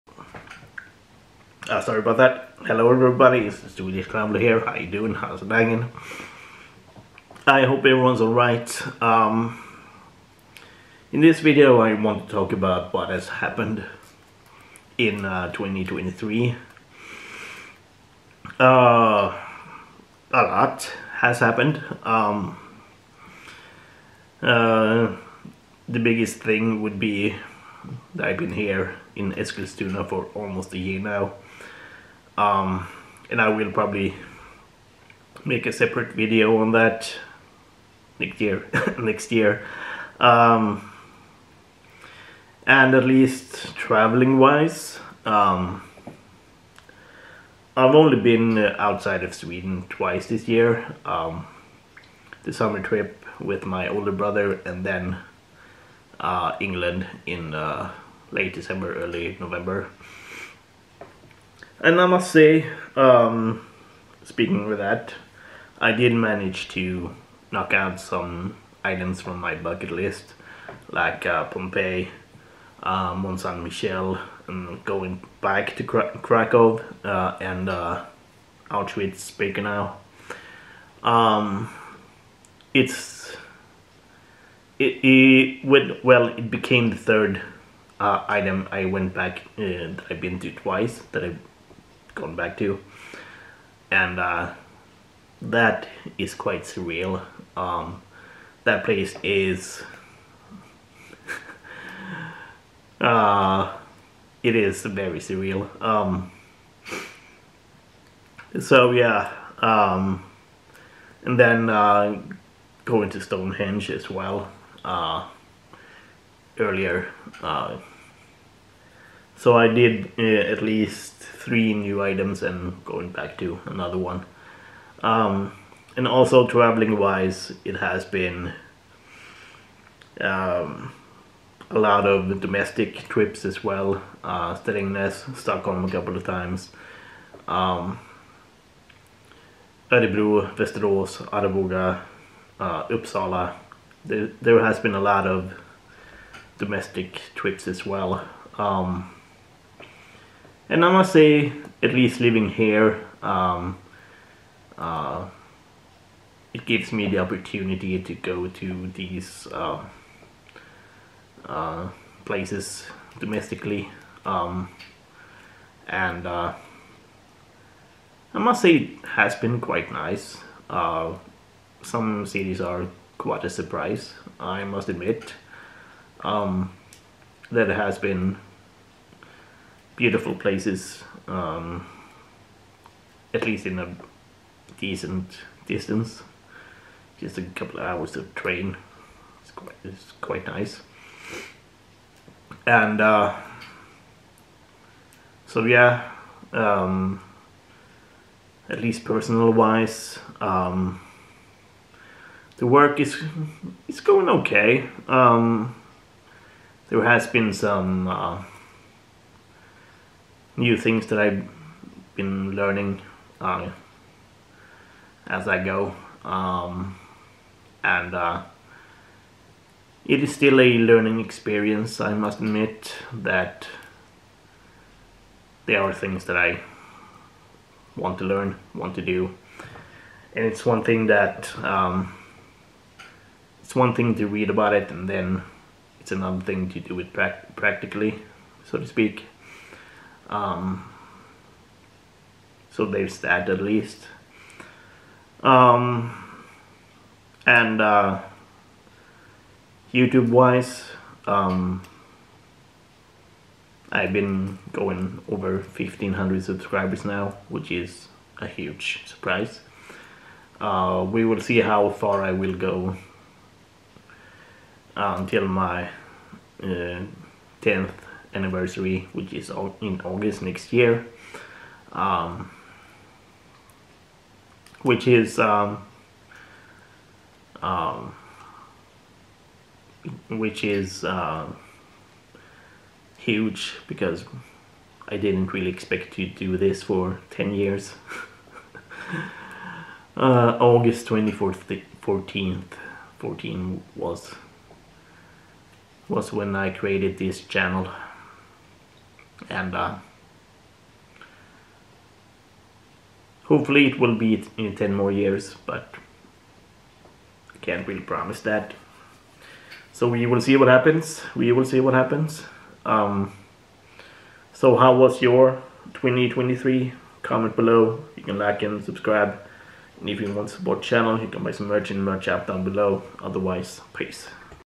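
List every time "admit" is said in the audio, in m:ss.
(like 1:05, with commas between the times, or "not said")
2:54, 3:42.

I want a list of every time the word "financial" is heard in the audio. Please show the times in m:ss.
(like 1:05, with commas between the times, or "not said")
not said.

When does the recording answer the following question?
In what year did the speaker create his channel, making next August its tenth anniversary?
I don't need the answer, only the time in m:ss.
4:51.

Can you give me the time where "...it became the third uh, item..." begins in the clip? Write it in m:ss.
1:26.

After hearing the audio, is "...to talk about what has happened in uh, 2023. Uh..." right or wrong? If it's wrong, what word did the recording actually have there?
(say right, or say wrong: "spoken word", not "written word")
right.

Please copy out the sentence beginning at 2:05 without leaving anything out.
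Um, and also traveling wise, it has been um, a lot of domestic trips as well.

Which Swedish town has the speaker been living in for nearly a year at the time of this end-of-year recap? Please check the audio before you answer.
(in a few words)
Eskilstuna.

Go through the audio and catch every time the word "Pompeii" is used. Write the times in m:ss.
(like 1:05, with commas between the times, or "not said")
1:11.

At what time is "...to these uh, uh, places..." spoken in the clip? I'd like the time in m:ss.
2:38.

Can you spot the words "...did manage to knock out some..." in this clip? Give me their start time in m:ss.
1:05.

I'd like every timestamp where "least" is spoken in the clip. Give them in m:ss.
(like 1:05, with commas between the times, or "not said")
0:43, 2:00, 2:31, 3:03, 3:18, 4:03.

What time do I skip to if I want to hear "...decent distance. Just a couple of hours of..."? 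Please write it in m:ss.
3:04.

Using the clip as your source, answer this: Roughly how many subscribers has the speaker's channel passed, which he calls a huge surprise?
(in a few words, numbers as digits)
1500.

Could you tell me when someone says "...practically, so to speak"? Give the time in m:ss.
3:57.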